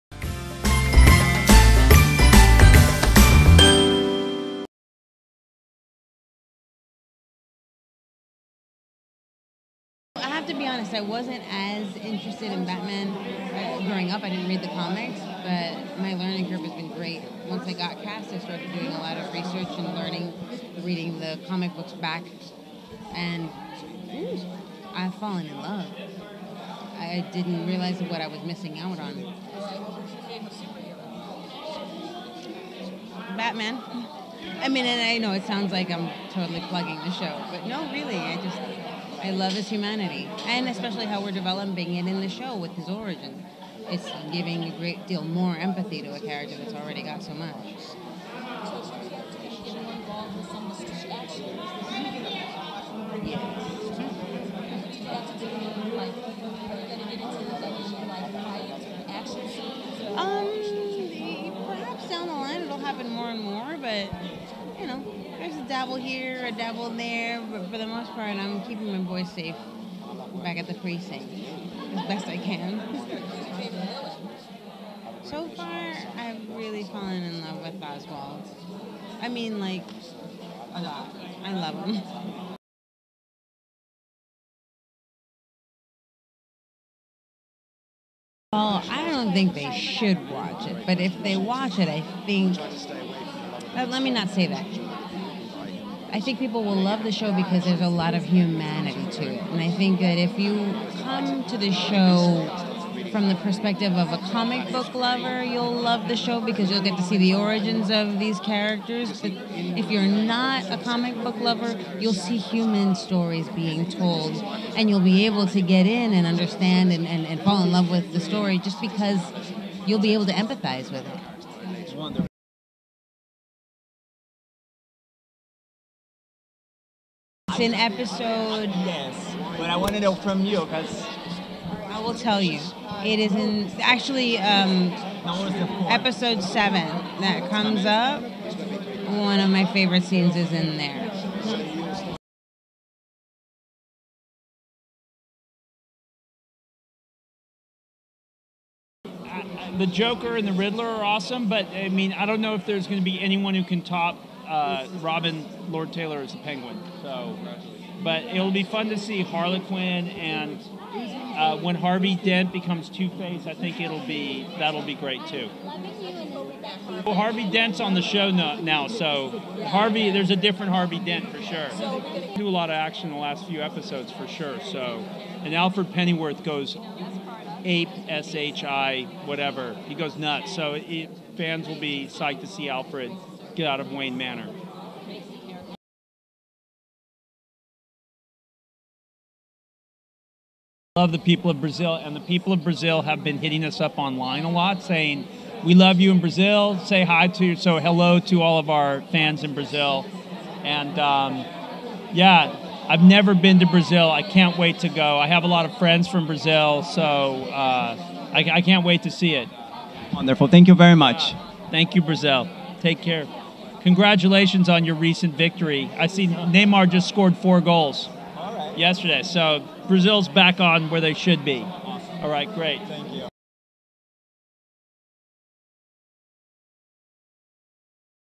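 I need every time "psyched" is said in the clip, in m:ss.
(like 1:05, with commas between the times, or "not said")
3:02.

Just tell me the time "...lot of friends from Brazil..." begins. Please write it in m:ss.
3:25.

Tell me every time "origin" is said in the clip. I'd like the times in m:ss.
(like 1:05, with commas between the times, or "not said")
0:42, 1:47.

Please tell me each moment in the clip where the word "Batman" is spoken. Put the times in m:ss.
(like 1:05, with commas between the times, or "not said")
0:12, 0:33.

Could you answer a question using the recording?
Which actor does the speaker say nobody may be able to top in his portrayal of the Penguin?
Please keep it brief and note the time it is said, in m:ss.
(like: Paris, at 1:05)
Robin Lord Taylor, at 2:35.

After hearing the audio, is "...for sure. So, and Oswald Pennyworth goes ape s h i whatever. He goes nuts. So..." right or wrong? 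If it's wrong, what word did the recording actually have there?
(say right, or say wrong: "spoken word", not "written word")
wrong: "Alfred", not "Oswald".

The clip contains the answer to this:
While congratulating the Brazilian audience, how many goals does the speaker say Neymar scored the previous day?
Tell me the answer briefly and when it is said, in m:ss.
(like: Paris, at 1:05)
4, at 3:37.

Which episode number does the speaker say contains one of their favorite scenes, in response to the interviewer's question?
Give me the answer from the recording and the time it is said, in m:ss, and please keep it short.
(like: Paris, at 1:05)
7, at 2:15.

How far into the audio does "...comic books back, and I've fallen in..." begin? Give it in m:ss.
0:21.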